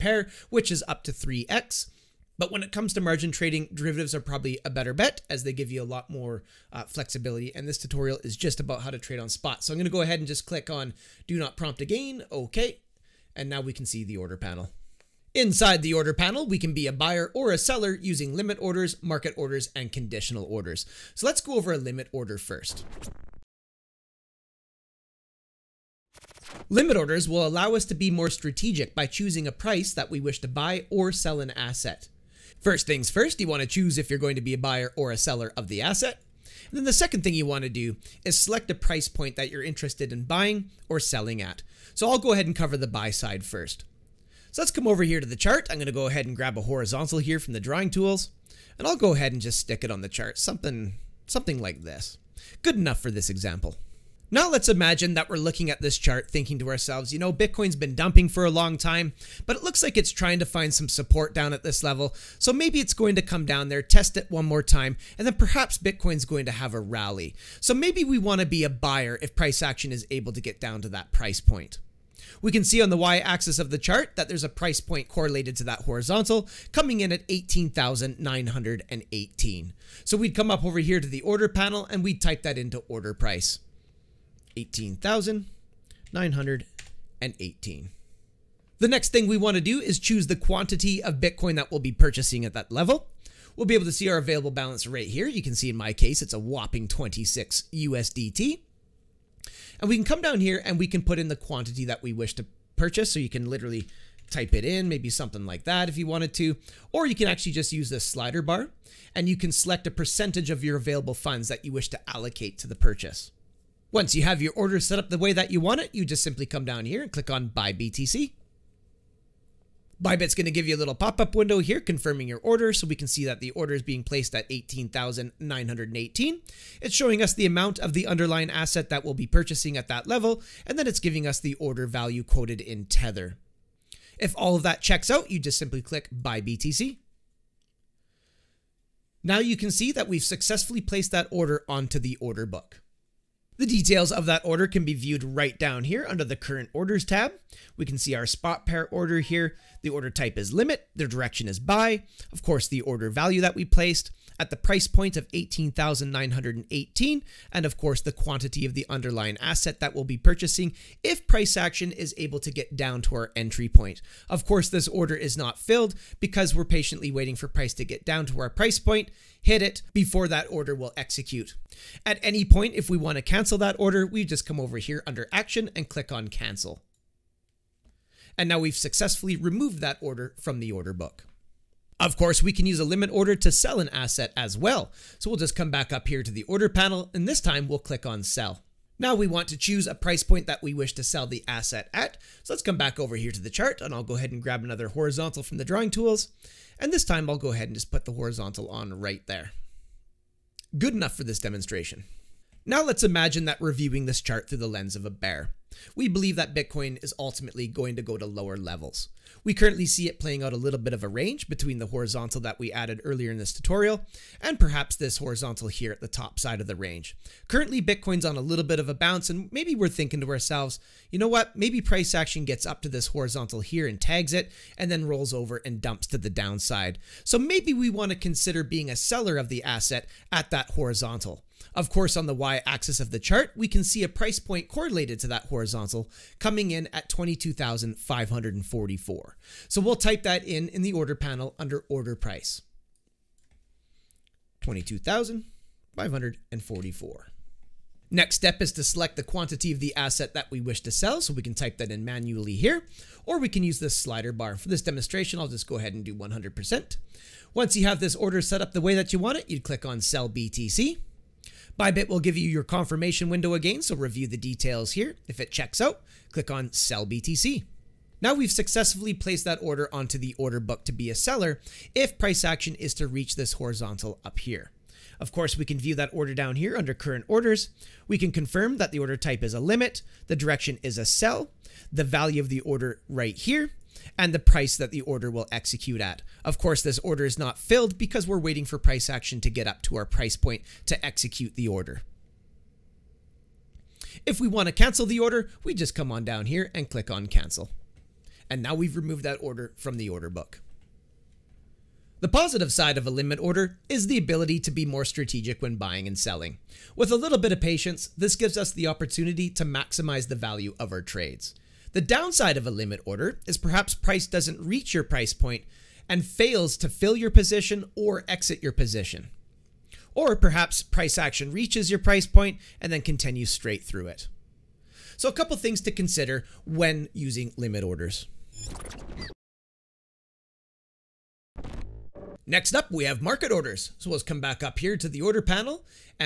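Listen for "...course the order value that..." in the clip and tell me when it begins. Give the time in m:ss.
2:32.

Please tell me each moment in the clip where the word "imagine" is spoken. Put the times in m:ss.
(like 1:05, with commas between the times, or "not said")
0:54, 3:23.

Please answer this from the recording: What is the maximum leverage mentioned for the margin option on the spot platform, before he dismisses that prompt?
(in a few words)
3x.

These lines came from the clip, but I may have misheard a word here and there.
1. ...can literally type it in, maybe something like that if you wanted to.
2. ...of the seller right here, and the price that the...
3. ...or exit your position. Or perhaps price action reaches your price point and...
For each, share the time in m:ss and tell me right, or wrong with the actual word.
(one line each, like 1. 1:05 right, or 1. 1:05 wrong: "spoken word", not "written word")
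1. 1:43 right
2. 4:42 wrong: "order", not "seller"
3. 5:17 right.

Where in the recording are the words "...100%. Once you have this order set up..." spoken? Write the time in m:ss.
4:16.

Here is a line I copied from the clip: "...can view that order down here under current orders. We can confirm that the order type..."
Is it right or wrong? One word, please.
right.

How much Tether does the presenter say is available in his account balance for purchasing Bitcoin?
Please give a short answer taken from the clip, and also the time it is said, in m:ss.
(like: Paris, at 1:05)
26 USDT, at 1:36.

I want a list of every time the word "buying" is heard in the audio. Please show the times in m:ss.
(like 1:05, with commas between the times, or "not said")
0:40, 5:05.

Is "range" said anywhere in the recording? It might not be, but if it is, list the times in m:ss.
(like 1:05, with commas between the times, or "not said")
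3:31, 3:36.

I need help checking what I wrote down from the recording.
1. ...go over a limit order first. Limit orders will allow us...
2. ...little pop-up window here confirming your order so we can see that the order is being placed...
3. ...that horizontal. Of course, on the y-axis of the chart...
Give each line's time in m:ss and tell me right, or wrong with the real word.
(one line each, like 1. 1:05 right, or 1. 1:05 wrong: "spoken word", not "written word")
1. 0:21 right
2. 2:00 right
3. 3:50 right.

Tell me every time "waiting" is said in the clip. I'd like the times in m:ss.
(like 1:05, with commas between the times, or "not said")
2:47, 4:48.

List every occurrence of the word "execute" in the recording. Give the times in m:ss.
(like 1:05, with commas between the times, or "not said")
2:50, 4:45, 4:51.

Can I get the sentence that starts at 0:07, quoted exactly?
And this tutorial is just about how to trade on spot.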